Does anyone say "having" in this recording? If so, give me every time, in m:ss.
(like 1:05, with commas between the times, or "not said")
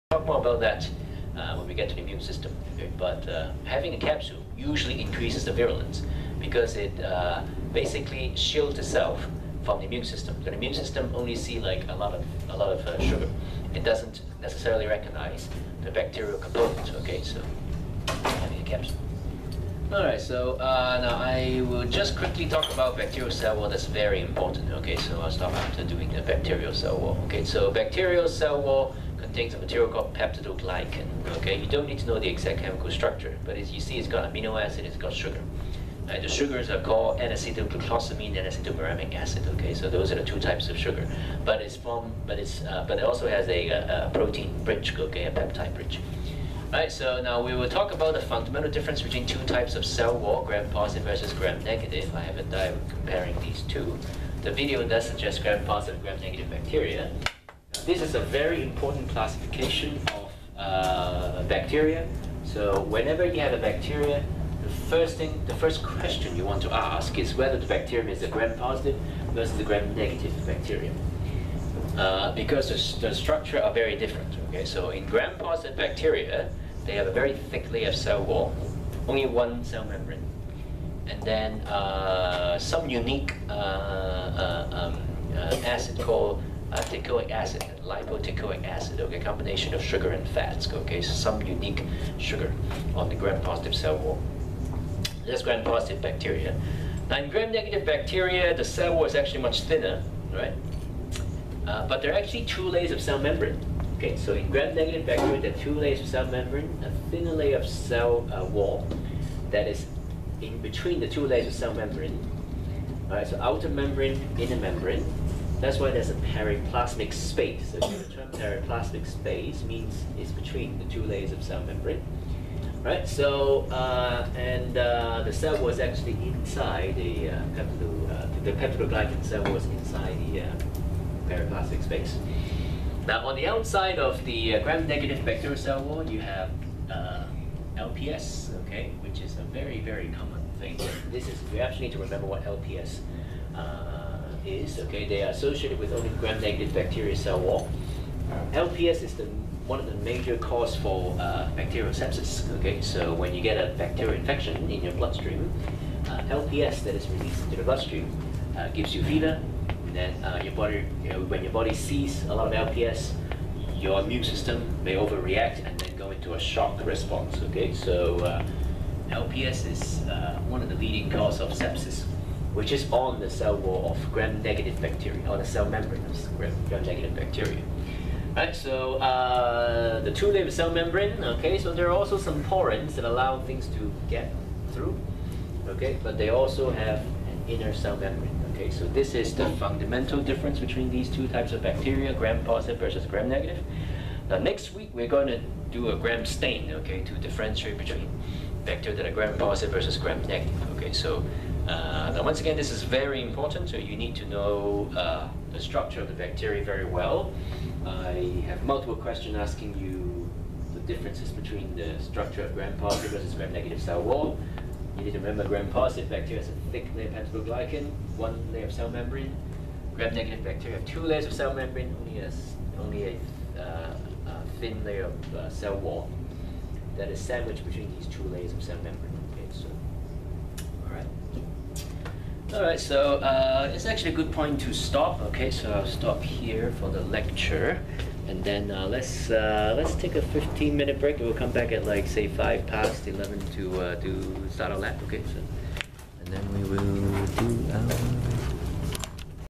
0:03, 0:18.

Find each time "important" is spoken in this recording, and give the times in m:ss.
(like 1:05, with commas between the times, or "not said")
0:24, 0:58, 3:23.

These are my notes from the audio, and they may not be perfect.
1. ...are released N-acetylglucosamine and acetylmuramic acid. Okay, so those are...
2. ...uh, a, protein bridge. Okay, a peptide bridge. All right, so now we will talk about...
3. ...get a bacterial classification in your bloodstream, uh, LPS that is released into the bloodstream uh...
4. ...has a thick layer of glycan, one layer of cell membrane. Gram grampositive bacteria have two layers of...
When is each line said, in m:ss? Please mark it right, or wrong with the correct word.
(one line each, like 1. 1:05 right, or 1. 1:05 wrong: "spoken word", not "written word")
1. 0:36 wrong: "called", not "released"
2. 0:43 right
3. 2:33 wrong: "infection", not "classification"
4. 3:36 wrong: "negative", not "grampositive".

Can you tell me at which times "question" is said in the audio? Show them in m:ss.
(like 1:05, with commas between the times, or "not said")
1:05, 3:28.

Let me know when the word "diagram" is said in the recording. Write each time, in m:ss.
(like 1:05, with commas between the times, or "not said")
0:52.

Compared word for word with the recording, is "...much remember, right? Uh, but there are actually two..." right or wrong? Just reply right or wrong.
wrong.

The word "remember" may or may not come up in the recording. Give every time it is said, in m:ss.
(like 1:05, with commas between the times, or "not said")
2:21, 3:35.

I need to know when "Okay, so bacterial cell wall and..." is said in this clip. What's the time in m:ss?
0:27.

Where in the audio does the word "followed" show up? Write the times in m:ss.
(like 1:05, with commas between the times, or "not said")
not said.